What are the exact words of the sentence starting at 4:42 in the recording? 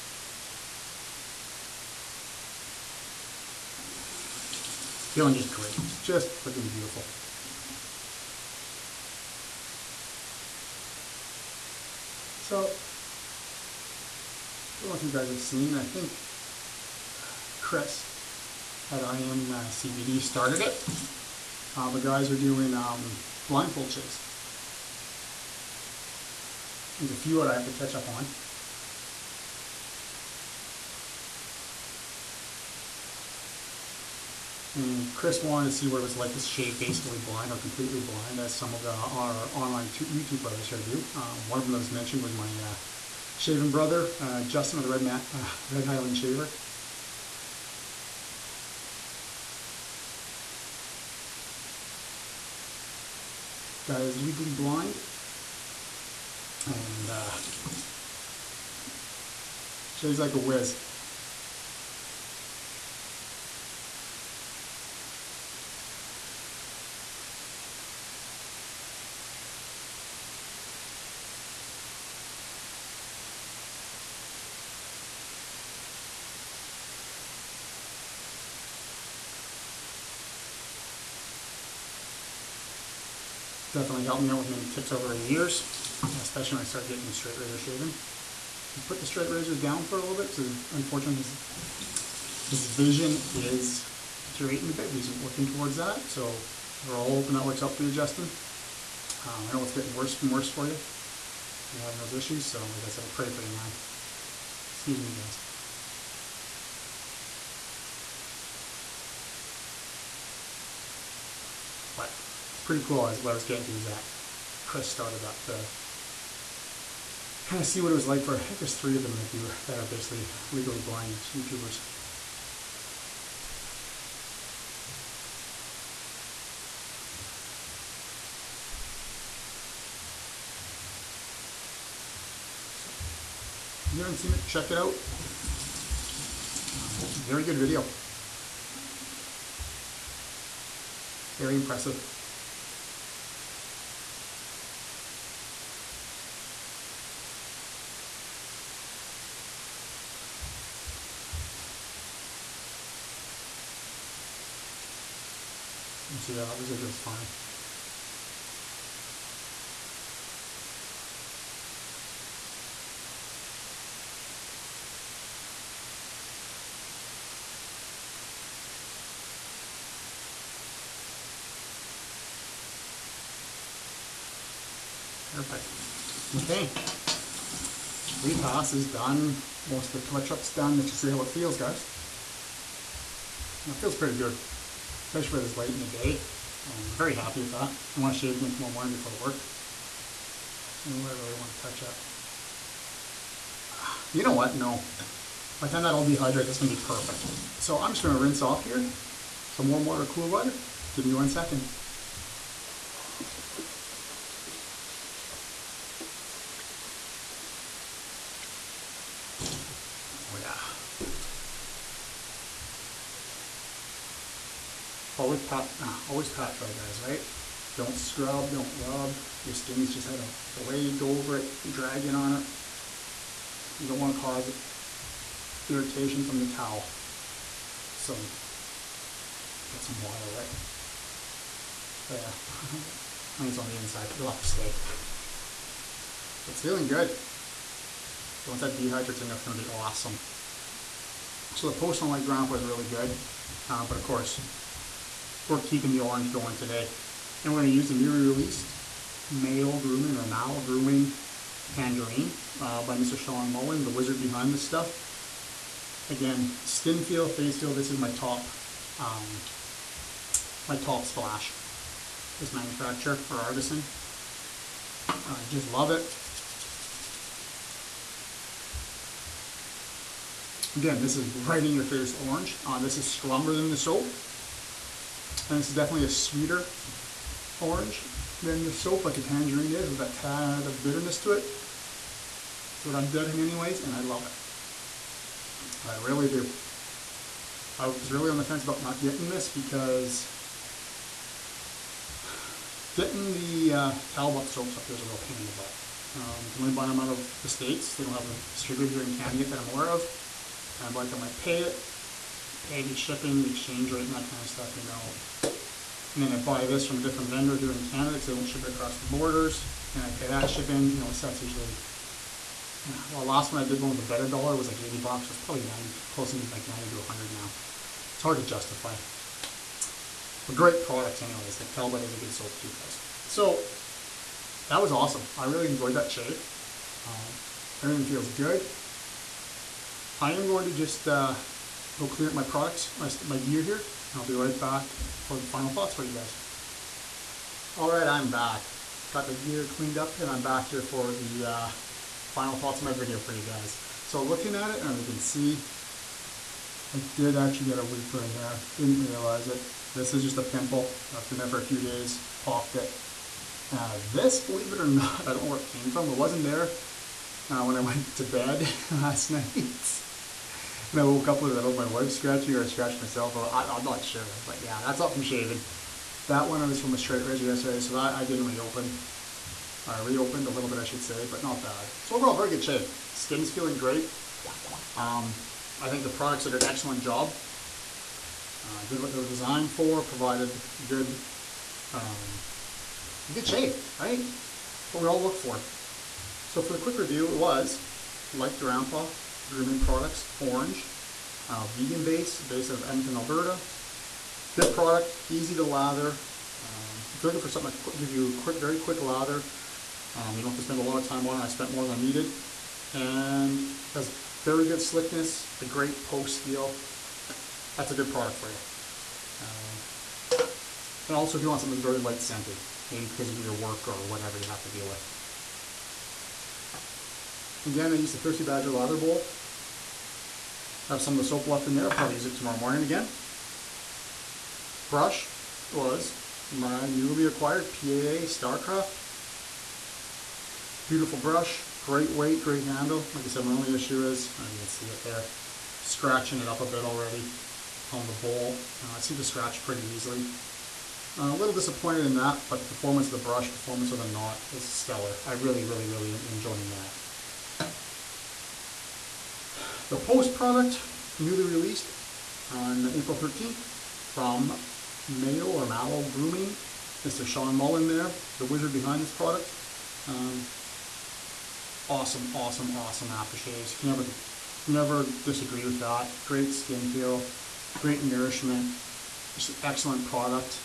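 That's what I'm getting anyways, and I love it.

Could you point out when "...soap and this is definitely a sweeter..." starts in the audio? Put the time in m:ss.
4:33.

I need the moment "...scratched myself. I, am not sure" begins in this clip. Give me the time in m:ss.
6:02.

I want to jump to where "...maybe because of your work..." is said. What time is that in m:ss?
6:52.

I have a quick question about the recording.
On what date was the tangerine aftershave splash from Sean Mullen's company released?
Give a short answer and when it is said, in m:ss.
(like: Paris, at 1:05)
April 13th, at 7:32.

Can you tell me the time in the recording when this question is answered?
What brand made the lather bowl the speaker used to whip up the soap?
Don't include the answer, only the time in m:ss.
6:58.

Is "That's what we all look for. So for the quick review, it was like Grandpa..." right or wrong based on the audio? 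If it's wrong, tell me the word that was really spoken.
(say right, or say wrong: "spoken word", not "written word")
right.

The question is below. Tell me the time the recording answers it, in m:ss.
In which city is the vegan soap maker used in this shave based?
6:32.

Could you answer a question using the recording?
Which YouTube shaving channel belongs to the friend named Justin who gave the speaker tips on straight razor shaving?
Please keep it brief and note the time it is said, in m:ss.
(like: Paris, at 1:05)
Red Highland Shaver, at 0:45.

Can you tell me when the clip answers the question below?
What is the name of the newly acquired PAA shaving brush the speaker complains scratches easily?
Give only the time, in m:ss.
7:08.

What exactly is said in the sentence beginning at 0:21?
Uh, the guys are doing um, blindfold chase.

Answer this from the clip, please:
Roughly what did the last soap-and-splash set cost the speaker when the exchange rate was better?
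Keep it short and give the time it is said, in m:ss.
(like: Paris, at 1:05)
80 bucks, at 5:14.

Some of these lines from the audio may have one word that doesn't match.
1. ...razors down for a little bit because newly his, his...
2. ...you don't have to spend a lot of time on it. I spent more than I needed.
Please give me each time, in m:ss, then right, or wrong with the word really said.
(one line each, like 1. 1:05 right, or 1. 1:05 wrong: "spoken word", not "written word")
1. 1:29 wrong: "unfortunately", not "newly"
2. 6:40 right.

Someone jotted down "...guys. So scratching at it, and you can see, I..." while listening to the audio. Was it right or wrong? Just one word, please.
wrong.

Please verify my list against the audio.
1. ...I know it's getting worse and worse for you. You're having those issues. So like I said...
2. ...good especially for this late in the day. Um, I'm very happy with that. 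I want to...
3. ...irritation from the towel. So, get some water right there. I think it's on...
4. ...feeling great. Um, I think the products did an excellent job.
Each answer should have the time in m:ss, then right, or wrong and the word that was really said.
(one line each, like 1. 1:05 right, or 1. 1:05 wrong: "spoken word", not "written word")
1. 1:39 right
2. 3:04 right
3. 3:45 right
4. 6:13 right.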